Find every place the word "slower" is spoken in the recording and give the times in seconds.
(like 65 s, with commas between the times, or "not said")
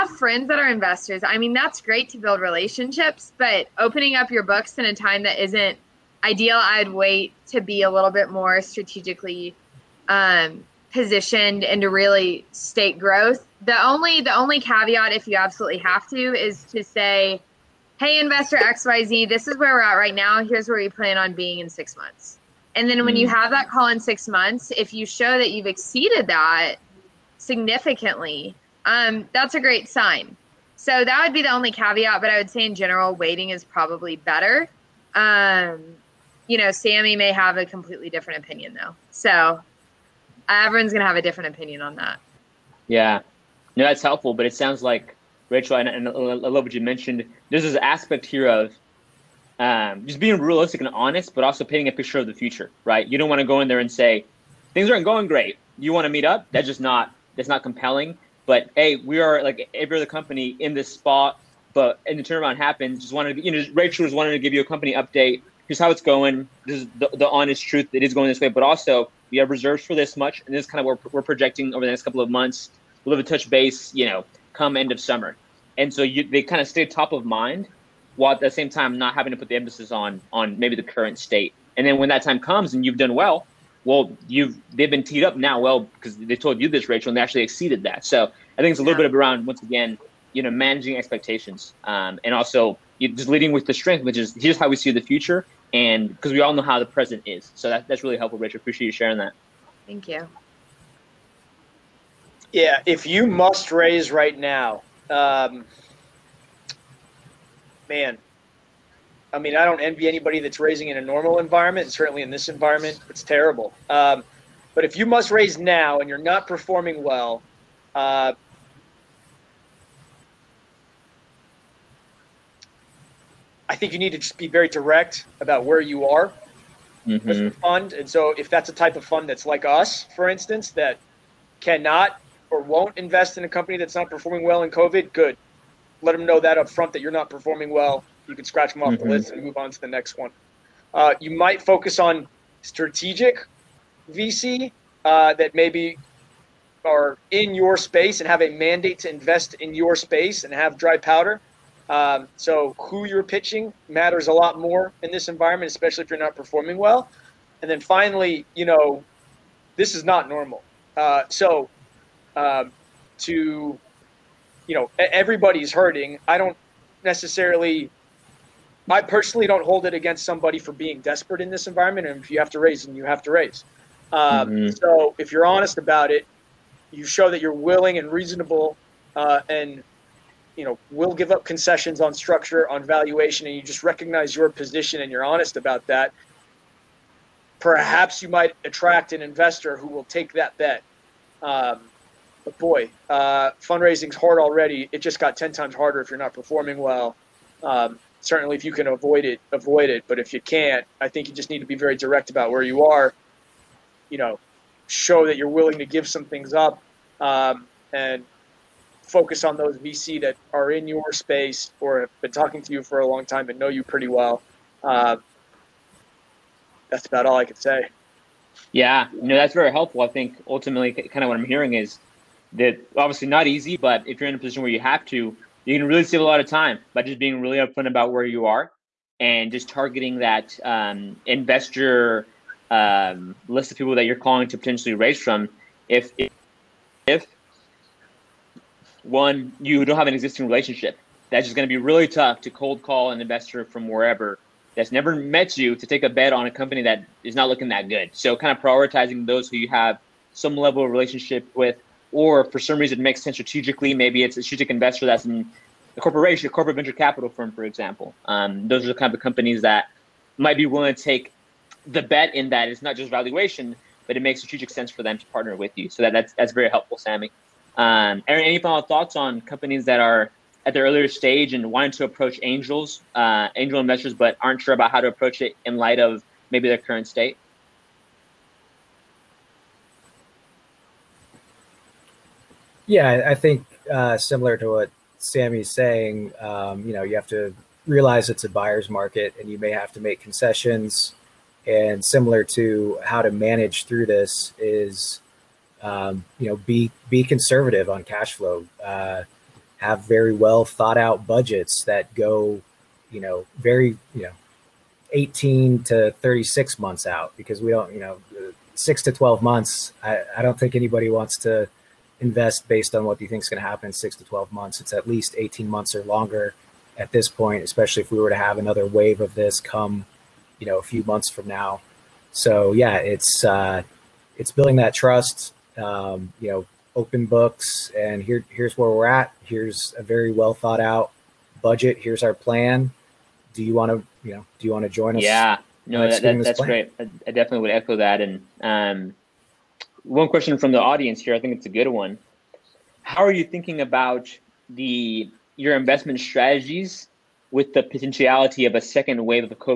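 not said.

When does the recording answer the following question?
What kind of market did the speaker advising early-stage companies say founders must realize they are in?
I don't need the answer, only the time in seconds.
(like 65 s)
288 s.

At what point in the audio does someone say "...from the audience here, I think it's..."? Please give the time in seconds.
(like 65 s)
340 s.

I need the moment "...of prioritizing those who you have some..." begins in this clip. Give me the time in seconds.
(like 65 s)
248 s.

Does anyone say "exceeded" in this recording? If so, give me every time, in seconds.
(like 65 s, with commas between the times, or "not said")
25 s, 87 s.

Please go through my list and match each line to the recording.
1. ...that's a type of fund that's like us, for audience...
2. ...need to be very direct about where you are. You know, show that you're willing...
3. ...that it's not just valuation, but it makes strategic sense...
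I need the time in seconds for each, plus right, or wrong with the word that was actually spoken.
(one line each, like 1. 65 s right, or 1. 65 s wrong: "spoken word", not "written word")
1. 128 s wrong: "instance", not "audience"
2. 201 s right
3. 262 s right.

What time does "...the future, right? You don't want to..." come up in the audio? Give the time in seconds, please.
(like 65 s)
52 s.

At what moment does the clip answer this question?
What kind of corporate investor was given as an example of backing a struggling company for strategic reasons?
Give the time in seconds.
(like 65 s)
256 s.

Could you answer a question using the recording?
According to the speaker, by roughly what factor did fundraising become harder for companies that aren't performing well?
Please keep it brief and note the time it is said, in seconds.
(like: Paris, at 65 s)
10 times, at 195 s.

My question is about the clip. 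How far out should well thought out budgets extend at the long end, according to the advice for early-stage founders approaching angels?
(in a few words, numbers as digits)
36 months.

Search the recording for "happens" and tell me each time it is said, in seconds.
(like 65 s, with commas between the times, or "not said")
62 s, 313 s.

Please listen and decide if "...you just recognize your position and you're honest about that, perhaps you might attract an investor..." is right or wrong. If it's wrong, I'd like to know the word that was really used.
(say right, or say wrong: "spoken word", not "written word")
right.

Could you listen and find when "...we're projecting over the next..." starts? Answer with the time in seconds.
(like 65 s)
71 s.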